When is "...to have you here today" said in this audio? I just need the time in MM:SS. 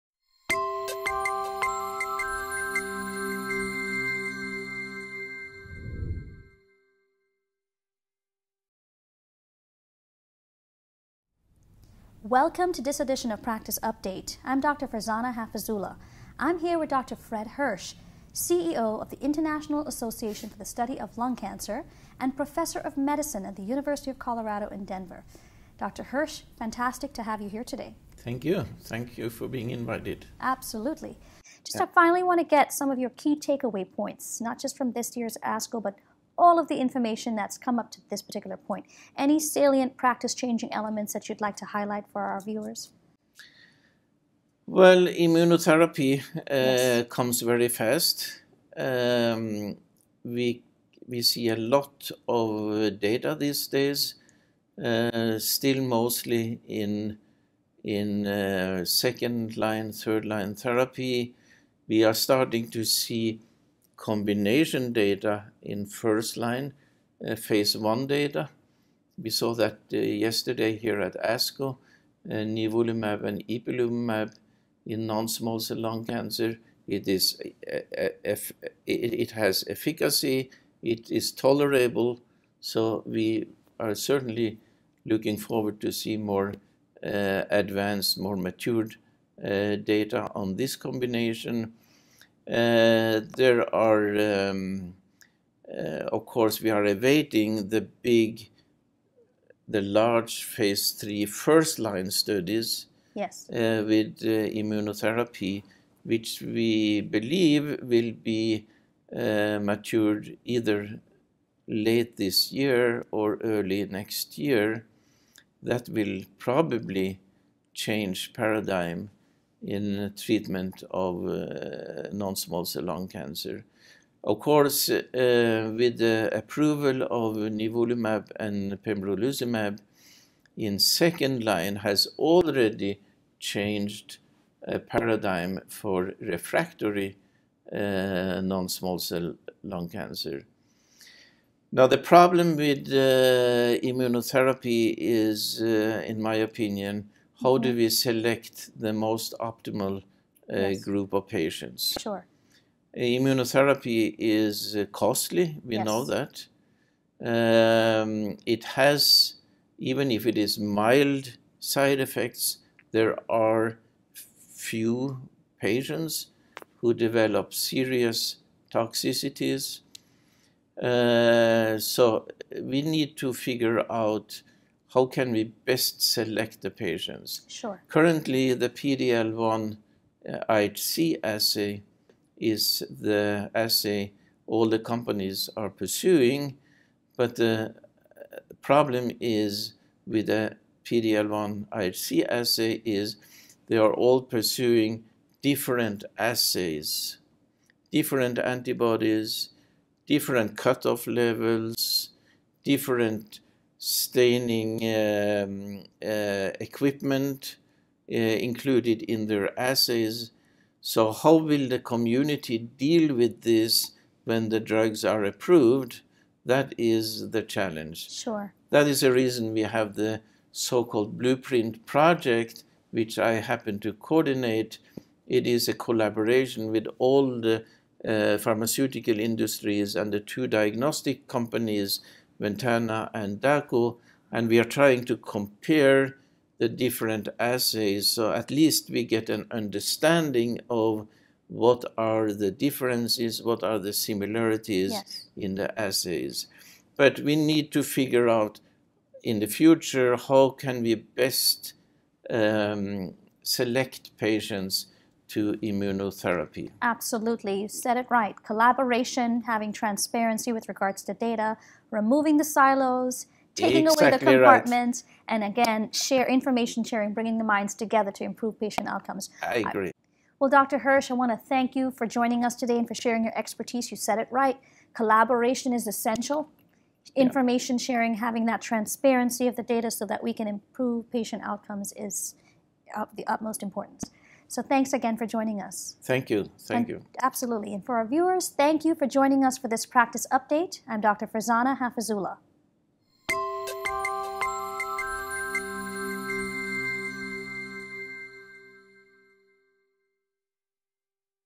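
00:27.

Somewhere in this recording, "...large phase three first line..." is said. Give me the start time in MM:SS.
01:39.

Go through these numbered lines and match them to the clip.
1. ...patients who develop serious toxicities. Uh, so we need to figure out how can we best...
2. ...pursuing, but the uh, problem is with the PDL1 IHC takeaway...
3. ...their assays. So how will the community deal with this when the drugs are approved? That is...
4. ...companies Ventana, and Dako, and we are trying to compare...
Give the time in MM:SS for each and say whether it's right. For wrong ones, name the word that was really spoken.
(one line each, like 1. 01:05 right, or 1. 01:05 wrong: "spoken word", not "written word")
1. 02:45 right
2. 03:05 wrong: "assay", not "takeaway"
3. 03:29 right
4. 03:51 right.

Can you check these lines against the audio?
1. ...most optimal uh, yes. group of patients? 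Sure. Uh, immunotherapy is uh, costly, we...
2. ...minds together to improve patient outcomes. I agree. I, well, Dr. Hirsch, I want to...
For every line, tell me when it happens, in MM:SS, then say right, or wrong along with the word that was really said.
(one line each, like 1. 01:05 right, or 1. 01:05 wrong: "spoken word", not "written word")
1. 02:28 right
2. 04:27 right.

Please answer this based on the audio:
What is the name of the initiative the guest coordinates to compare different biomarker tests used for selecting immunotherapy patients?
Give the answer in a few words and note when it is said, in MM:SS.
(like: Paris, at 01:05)
Blueprint Project, at 03:41.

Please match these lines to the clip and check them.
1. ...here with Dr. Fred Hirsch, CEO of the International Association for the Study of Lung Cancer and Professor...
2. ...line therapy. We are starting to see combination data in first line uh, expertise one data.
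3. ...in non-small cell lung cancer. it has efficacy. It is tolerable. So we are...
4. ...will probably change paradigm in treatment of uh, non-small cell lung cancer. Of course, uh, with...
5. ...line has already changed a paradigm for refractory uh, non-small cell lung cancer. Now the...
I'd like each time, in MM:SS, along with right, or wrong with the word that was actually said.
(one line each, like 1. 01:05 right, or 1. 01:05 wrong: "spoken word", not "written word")
1. 00:16 right
2. 01:00 wrong: "phase", not "expertise"
3. 01:14 right
4. 01:55 right
5. 02:11 right.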